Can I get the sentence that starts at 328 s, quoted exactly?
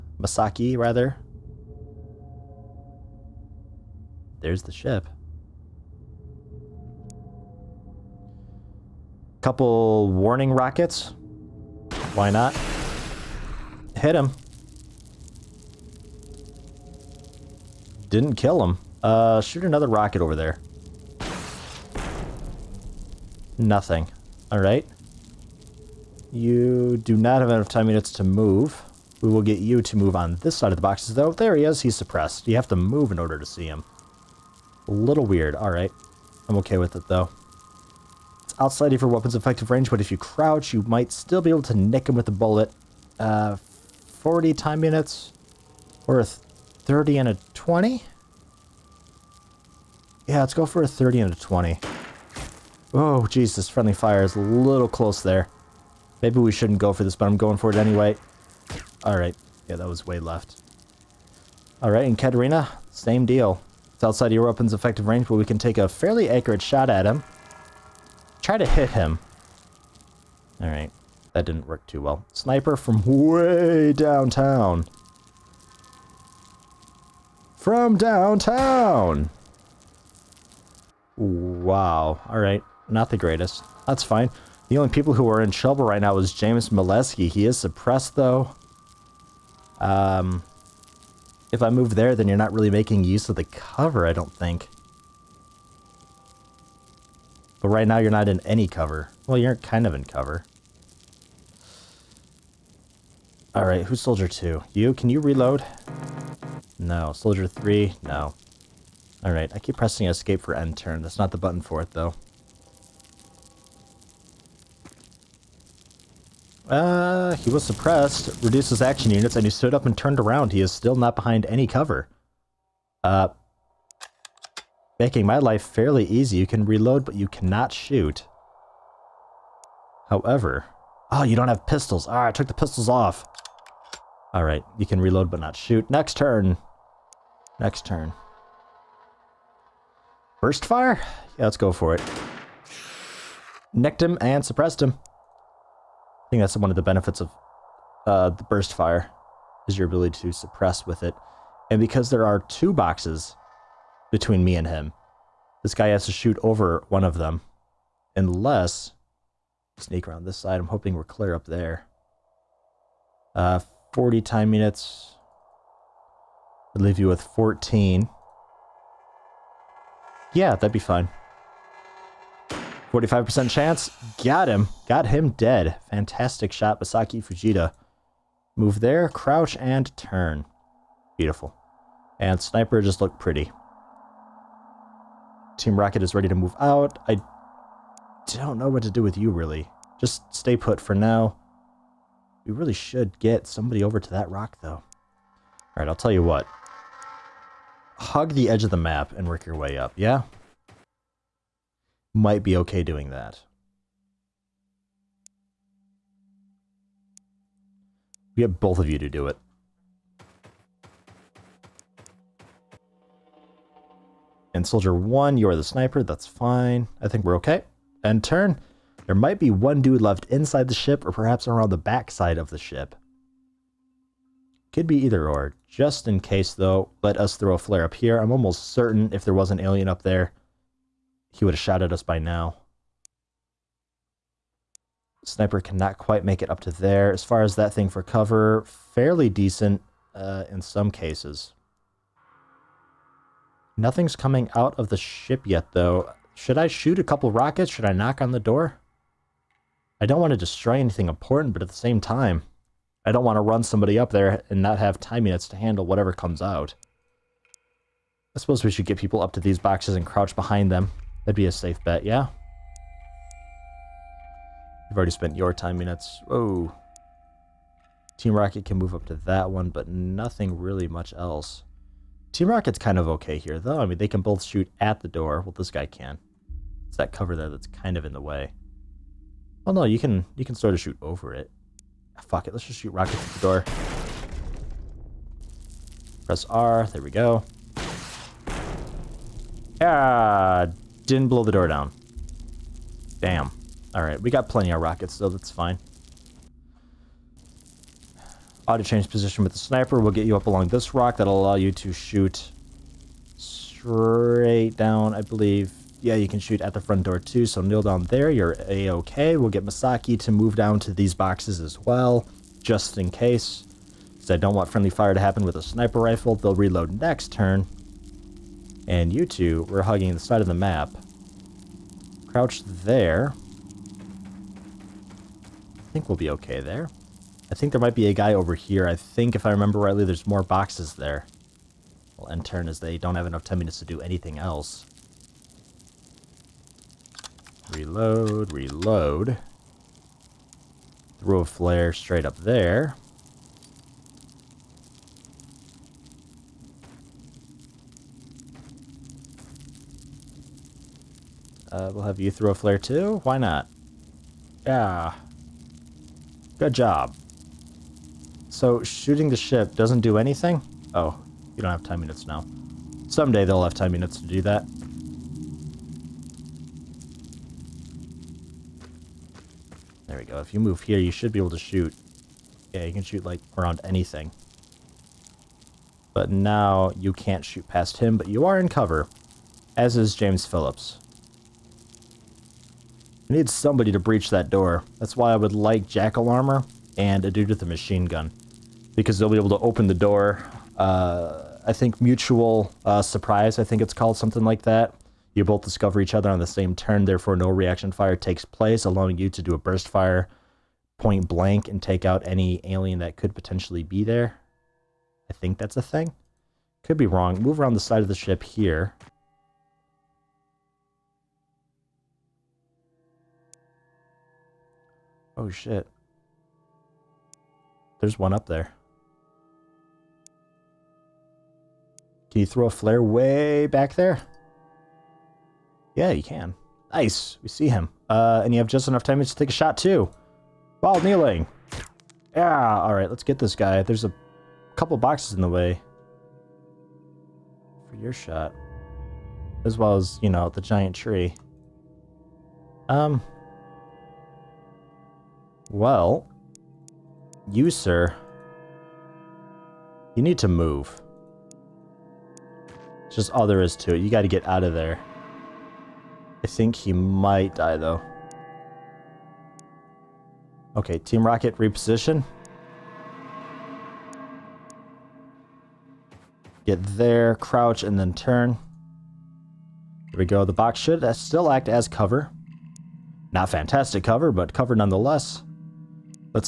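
I think, if I remember rightly, there's more boxes there.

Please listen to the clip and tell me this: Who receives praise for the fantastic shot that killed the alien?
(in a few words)
Masaki Fujita.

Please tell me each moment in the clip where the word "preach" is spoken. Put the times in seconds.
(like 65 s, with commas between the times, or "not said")
not said.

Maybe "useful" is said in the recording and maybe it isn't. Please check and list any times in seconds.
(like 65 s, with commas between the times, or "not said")
not said.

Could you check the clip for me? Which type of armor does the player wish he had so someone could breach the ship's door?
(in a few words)
Jackal armor.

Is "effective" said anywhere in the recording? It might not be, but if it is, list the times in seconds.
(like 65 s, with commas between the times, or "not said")
39 s, 64 s.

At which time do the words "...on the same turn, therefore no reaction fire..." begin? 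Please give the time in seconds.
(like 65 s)
396 s.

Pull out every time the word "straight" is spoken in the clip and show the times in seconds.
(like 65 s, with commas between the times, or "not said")
303 s, 341 s.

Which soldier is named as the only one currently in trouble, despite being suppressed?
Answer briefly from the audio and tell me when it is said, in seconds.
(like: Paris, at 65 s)
James Molesky, at 86 s.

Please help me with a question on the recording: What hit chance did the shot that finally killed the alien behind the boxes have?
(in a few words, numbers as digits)
45%.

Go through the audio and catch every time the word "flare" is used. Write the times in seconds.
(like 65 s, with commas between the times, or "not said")
227 s, 341 s, 352 s, 422 s.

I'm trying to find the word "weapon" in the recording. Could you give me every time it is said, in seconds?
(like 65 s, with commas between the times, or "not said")
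39 s, 64 s.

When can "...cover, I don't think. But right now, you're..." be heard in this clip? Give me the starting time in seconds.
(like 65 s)
93 s.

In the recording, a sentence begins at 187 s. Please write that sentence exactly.
I don't know what to do with you, really.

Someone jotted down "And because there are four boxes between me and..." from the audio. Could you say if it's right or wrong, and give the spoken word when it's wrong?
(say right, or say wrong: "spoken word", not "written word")
wrong: "two", not "four".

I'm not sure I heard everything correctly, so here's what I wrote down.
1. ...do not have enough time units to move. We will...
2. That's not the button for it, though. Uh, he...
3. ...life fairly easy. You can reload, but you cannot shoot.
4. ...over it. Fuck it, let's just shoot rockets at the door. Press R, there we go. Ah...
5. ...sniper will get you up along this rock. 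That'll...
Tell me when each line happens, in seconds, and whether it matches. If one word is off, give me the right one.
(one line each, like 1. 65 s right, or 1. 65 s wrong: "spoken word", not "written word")
1. 26 s right
2. 111 s right
3. 125 s right
4. 281 s right
5. 299 s right.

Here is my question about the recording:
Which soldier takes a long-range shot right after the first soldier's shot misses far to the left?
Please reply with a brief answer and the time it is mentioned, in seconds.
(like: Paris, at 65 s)
Katarina, at 62 s.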